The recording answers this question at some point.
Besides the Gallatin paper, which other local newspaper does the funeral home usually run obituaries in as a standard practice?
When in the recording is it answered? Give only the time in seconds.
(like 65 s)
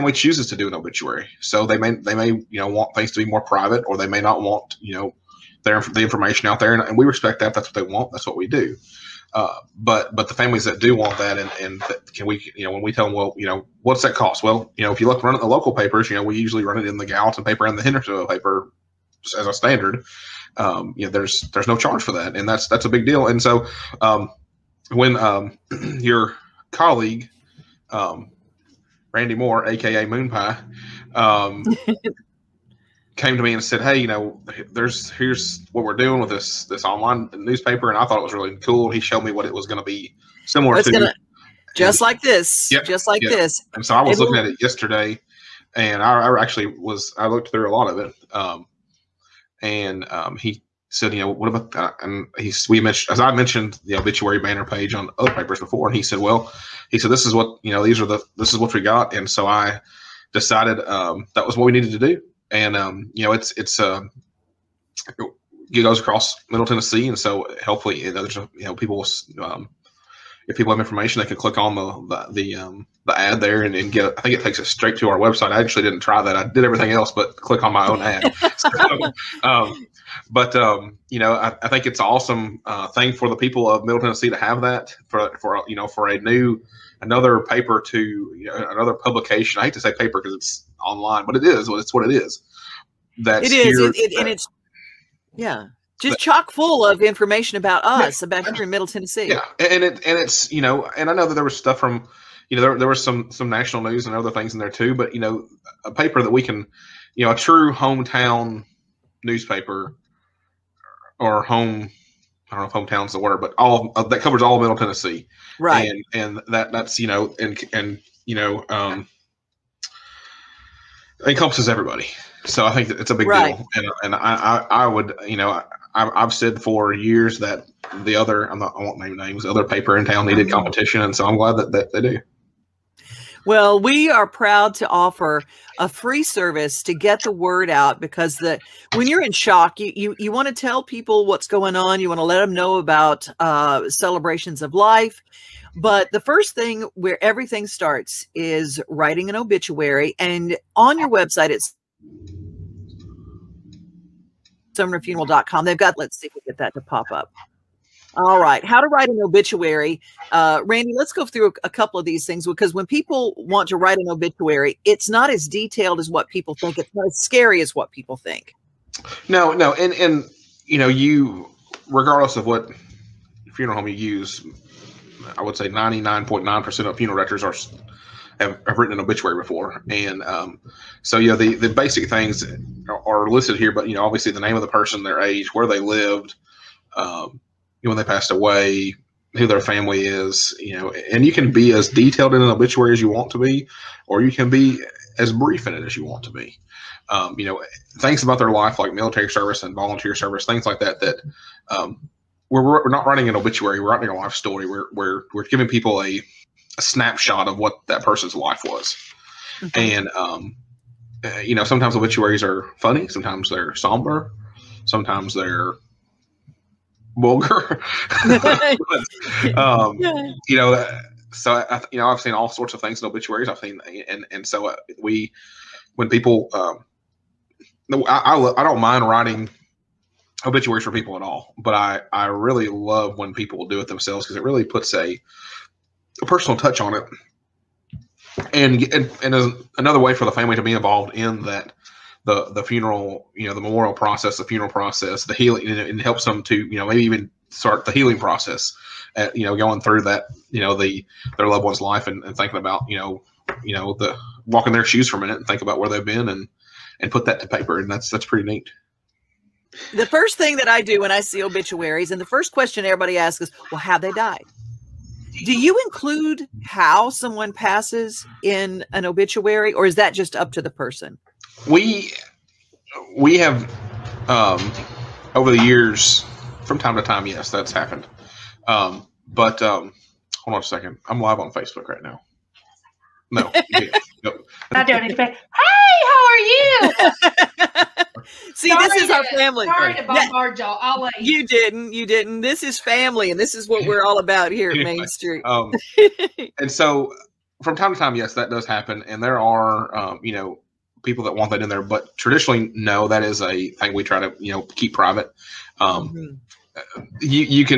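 17 s.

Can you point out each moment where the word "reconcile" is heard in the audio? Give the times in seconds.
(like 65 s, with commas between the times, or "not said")
not said.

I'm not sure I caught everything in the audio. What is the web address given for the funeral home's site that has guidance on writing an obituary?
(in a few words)
sumnerfuneral.com.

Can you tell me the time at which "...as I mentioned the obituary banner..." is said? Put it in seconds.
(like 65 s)
53 s.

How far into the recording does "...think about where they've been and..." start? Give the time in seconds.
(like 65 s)
255 s.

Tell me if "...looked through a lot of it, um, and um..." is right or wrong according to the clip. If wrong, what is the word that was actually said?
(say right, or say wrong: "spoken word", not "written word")
right.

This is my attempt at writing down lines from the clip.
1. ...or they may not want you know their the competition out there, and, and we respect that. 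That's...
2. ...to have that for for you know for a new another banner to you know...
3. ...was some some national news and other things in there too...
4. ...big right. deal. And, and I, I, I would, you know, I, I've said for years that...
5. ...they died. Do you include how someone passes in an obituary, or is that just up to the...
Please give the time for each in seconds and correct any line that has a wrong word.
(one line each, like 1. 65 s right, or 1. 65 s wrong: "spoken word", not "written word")
1. 3 s wrong: "information", not "competition"
2. 84 s wrong: "paper", not "banner"
3. 102 s right
4. 123 s right
5. 263 s right.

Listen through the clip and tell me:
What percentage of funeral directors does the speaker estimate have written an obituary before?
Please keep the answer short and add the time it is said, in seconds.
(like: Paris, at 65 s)
99.9%, at 175 s.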